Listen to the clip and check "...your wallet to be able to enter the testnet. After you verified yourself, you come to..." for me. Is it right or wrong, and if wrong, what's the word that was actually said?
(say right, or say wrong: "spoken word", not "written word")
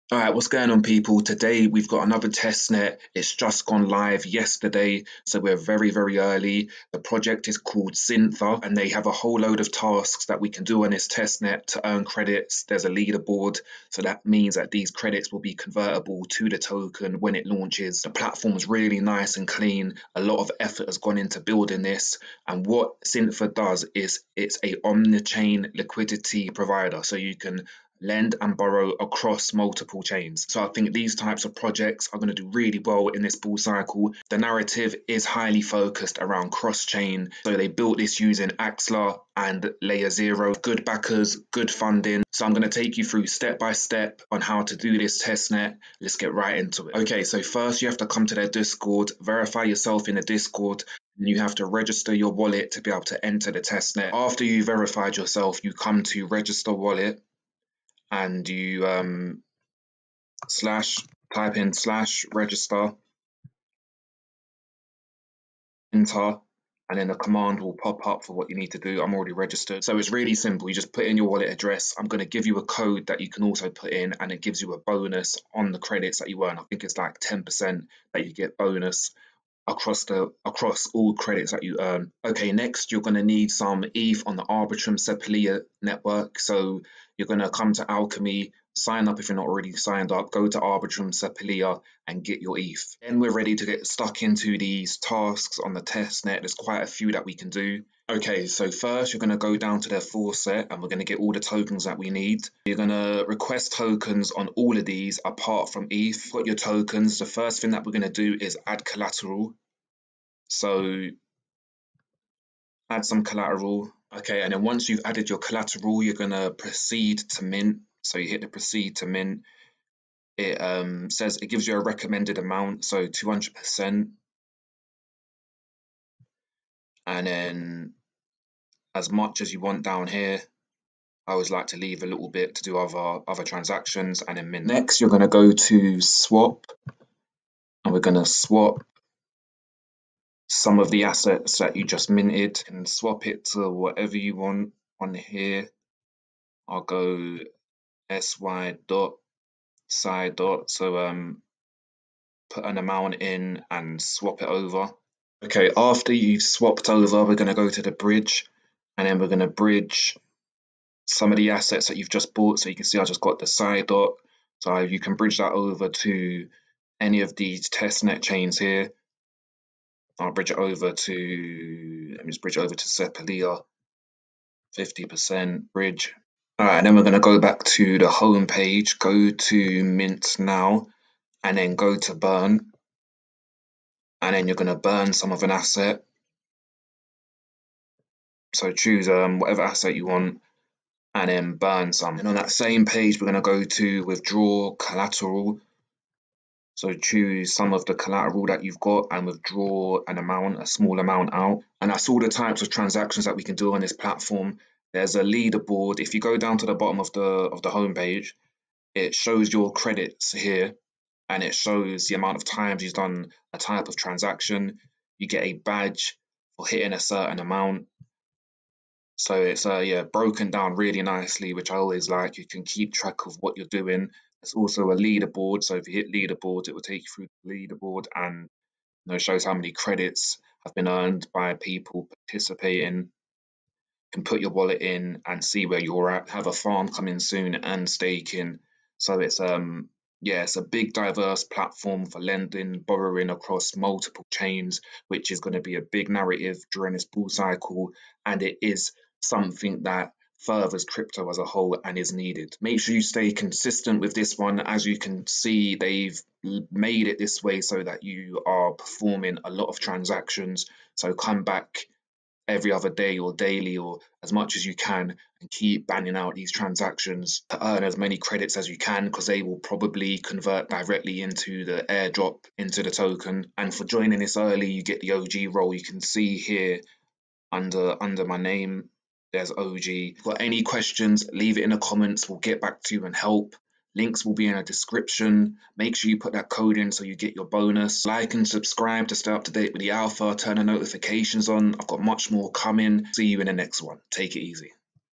right.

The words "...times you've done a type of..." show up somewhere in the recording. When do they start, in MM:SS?
03:32.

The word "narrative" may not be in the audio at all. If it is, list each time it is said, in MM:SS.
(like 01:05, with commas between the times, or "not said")
00:34, 04:06.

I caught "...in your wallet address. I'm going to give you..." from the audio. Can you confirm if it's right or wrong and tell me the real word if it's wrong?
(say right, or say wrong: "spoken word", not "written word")
right.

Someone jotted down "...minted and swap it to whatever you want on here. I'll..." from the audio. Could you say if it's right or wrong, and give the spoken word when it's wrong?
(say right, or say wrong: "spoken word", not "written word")
right.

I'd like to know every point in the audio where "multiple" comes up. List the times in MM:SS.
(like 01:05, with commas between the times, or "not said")
00:29, 04:03.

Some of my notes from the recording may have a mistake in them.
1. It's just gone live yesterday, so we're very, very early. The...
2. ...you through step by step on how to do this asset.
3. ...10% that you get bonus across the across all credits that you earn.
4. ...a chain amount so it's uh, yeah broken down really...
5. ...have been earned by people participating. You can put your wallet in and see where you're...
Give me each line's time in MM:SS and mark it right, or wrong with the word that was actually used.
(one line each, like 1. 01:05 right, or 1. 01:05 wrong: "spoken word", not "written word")
1. 00:03 right
2. 00:42 wrong: "testnet", not "asset"
3. 01:17 right
4. 03:36 wrong: "certain", not "chain"
5. 03:50 right.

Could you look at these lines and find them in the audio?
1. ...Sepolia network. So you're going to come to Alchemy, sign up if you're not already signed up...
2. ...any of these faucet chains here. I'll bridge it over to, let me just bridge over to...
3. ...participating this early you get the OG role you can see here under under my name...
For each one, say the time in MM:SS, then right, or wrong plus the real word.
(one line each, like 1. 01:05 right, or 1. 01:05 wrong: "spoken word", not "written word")
1. 01:24 right
2. 02:46 wrong: "testnet", not "faucet"
3. 04:33 wrong: "joining", not "participating".